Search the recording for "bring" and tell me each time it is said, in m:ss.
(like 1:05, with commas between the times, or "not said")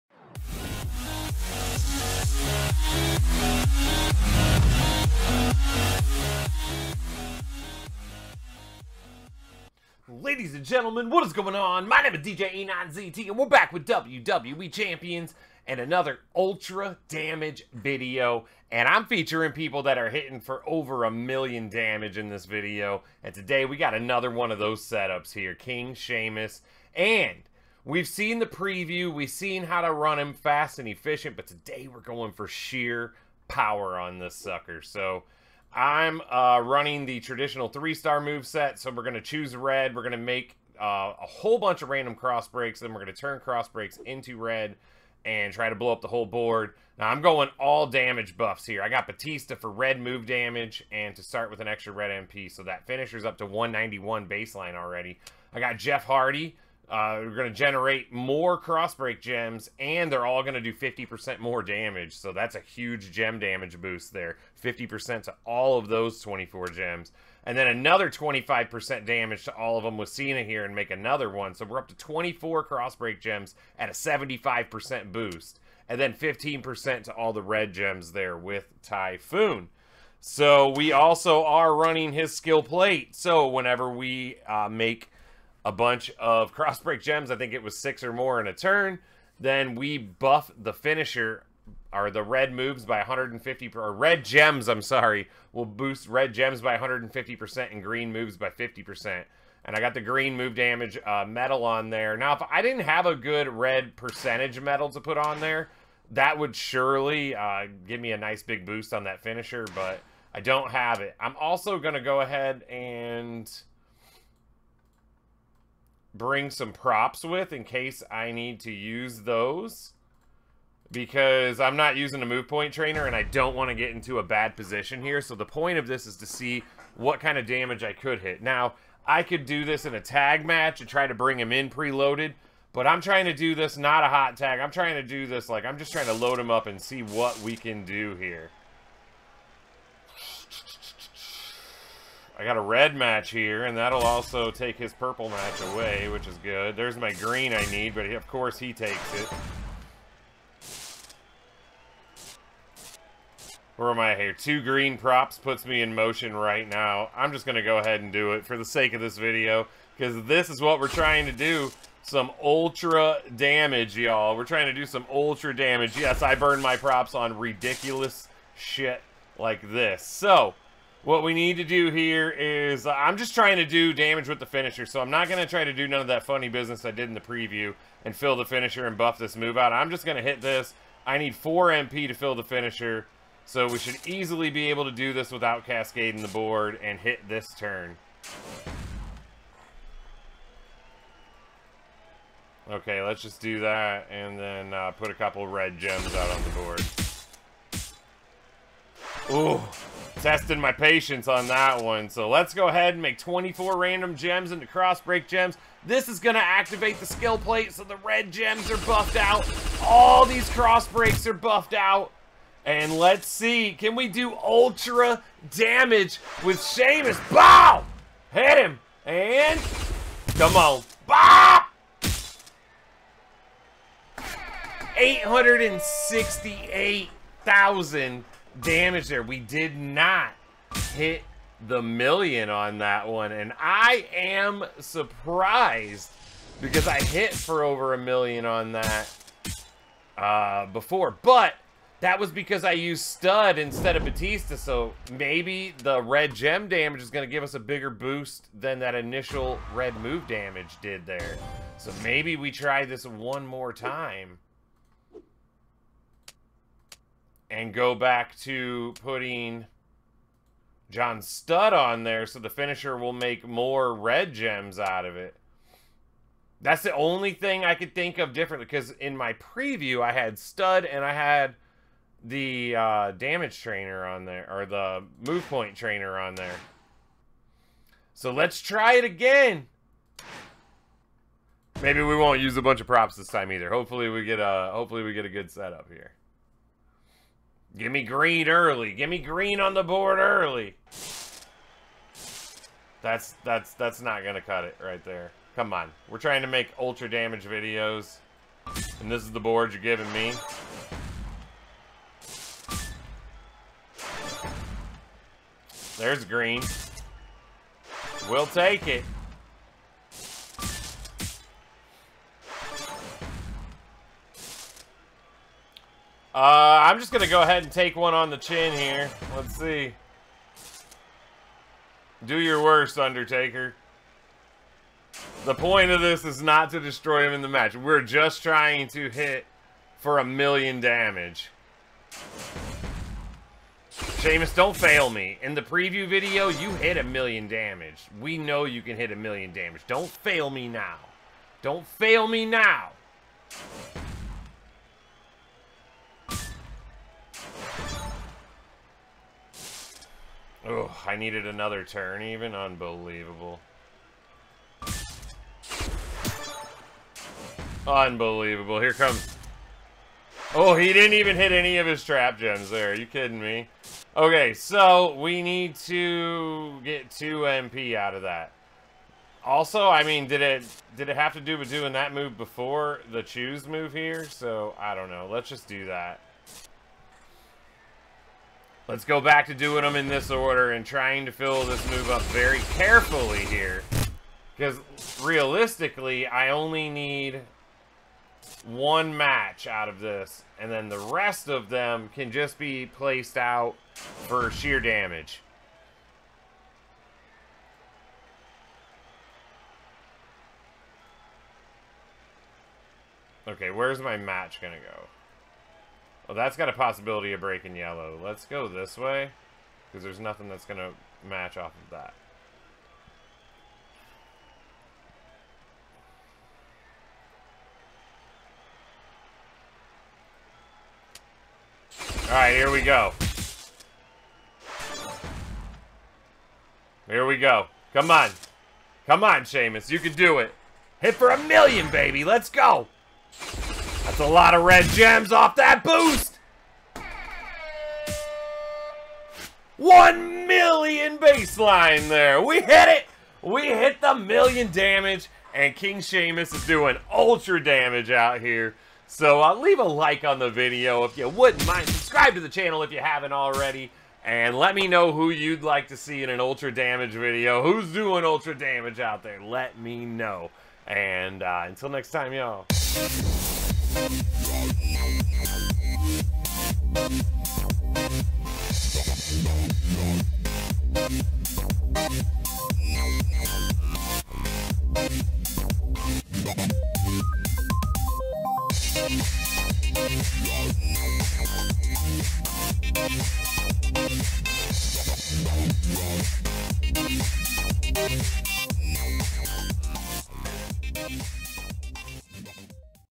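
1:56, 2:11.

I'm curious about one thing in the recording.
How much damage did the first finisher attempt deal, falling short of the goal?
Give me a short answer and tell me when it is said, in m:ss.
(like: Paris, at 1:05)
868,000, at 3:44.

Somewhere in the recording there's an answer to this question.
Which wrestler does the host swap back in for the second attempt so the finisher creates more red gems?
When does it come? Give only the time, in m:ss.
4:20.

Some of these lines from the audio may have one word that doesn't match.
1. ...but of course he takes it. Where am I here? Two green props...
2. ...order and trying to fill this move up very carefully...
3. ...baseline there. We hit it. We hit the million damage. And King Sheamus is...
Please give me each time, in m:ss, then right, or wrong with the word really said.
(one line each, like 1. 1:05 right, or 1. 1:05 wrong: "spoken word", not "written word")
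1. 2:27 right
2. 6:20 right
3. 7:21 right.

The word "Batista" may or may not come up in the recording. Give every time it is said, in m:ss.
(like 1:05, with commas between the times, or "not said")
0:49, 4:04.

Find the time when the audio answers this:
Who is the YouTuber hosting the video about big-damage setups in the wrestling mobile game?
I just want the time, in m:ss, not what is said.
0:12.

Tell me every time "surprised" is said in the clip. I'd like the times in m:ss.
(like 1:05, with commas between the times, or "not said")
3:54.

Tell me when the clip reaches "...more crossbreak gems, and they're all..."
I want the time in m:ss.
0:58.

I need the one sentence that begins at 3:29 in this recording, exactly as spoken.
All these crossbreaks are buffed out.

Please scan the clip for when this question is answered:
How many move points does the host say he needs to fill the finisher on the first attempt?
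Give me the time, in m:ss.
3:01.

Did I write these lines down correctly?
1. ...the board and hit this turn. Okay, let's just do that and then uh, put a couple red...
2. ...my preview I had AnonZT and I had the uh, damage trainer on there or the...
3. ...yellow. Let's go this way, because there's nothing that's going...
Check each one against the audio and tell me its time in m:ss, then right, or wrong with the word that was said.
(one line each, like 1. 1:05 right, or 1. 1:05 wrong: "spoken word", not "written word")
1. 3:06 right
2. 4:29 wrong: "Studd", not "AnonZT"
3. 6:47 right.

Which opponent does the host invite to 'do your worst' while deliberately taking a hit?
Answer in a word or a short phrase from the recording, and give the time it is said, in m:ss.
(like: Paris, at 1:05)
Undertaker, at 5:22.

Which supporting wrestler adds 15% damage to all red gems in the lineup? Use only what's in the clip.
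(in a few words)
Typhoon.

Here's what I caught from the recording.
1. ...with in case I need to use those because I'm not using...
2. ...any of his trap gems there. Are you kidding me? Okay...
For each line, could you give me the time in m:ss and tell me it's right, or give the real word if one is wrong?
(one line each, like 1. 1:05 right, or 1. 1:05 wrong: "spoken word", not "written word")
1. 1:57 right
2. 6:01 right.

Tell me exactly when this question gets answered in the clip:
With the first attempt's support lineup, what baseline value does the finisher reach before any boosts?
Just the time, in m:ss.
0:53.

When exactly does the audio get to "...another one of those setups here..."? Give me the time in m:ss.
0:23.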